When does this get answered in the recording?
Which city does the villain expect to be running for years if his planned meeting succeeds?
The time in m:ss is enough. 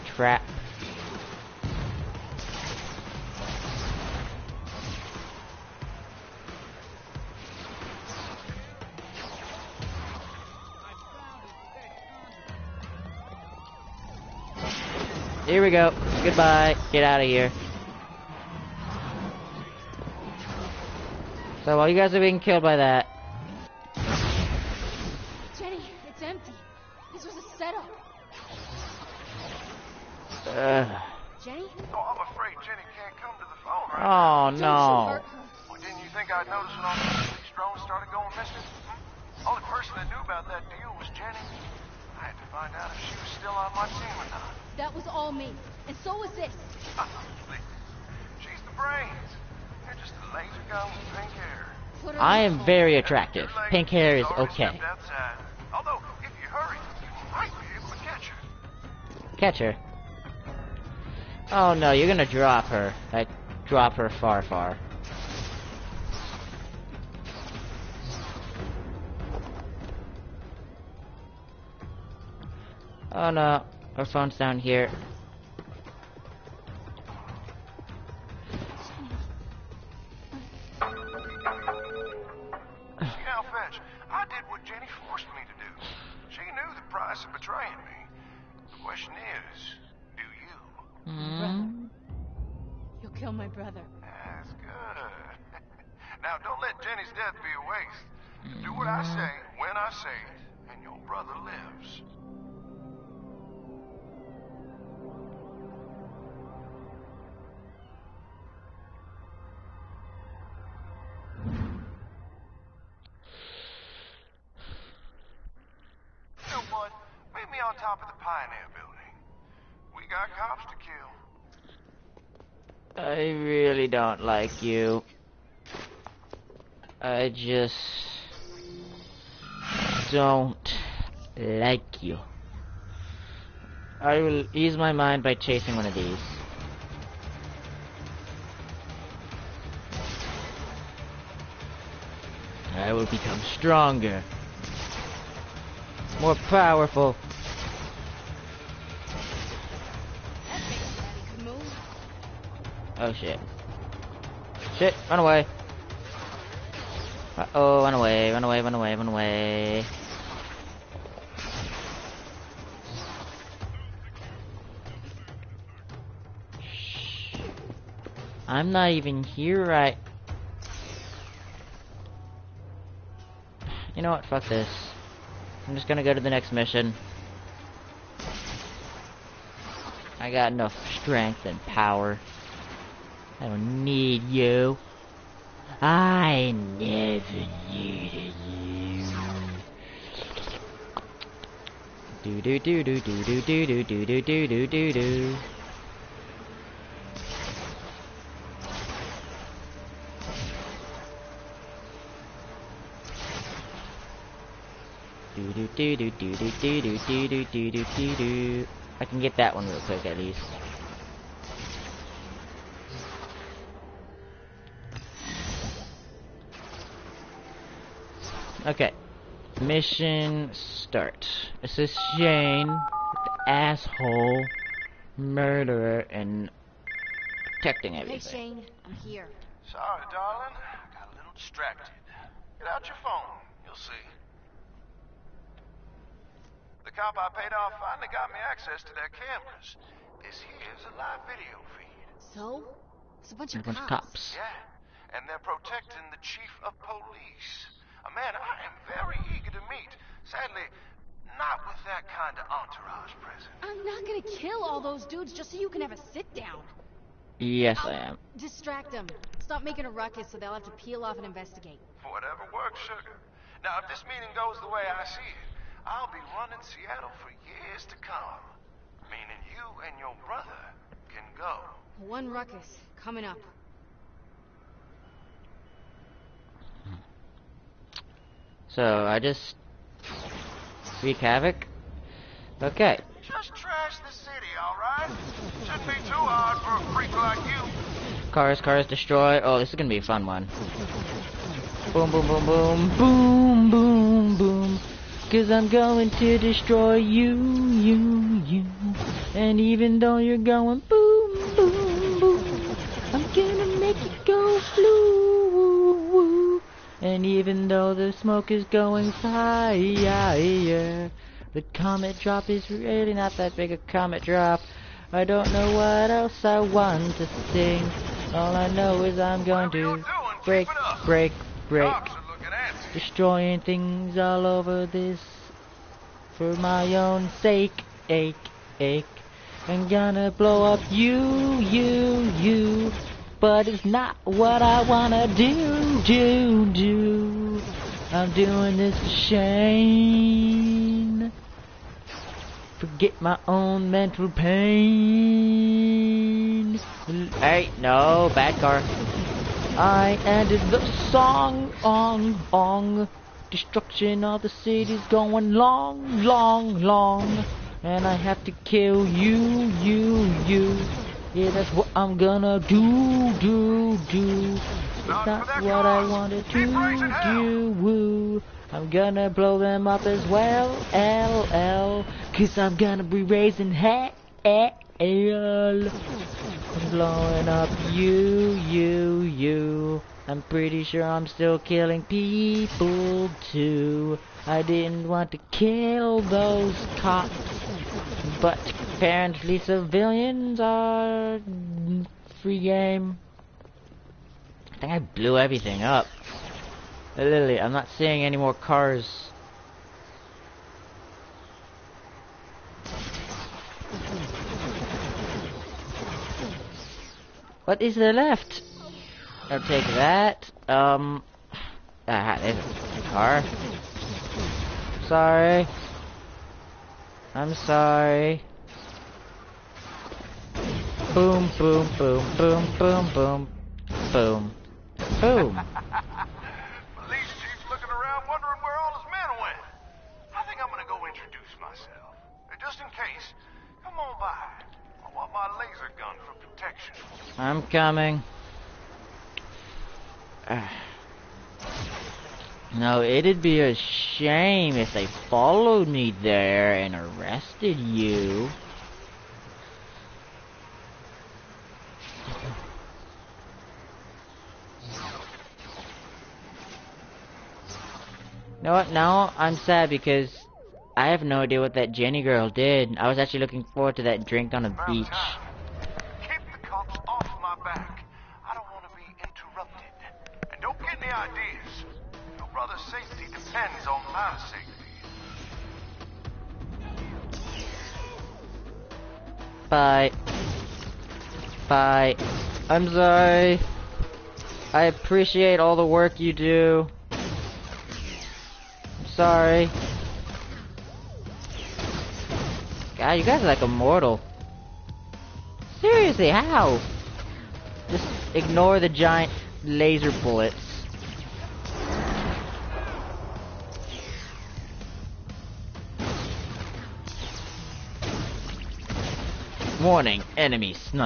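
4:26.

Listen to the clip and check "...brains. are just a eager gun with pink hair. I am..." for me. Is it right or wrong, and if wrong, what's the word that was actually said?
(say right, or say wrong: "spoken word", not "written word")
wrong: "laser", not "eager".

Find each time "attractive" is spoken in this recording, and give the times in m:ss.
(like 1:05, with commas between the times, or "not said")
0:52.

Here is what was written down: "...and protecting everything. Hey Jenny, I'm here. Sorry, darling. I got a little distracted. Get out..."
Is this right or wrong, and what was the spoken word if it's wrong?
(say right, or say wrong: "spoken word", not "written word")
wrong: "Shane", not "Jenny".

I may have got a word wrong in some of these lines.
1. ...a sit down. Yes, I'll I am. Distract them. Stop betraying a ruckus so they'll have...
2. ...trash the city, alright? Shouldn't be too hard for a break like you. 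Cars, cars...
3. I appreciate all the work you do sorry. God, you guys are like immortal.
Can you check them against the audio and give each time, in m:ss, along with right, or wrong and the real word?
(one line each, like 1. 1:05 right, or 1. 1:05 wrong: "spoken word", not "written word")
1. 4:15 wrong: "making", not "betraying"
2. 4:43 wrong: "freak", not "break"
3. 8:04 right.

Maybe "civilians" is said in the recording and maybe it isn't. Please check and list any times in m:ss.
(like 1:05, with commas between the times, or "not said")
6:29.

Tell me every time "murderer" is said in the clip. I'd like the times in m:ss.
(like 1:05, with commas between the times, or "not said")
3:45.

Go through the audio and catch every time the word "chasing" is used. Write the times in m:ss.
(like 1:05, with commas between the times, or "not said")
2:15.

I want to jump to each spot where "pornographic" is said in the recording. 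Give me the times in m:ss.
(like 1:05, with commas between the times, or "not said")
not said.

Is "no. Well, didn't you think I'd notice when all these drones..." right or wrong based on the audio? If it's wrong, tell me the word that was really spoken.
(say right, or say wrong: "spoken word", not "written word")
right.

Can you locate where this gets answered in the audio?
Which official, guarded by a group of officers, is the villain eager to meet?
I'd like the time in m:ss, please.
4:06.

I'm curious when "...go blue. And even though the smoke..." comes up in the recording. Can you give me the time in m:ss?
5:04.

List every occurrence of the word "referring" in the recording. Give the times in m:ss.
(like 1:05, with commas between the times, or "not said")
not said.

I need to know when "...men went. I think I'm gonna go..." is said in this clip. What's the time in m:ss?
7:09.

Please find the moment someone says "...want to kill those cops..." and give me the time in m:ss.
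6:25.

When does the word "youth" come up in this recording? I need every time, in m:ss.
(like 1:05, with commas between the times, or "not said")
not said.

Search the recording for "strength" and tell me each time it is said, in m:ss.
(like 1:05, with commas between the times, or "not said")
3:00.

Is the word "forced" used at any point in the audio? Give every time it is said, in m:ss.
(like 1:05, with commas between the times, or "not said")
1:25.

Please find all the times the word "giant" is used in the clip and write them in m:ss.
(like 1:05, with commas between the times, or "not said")
8:18.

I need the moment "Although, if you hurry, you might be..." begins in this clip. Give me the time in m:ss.
0:55.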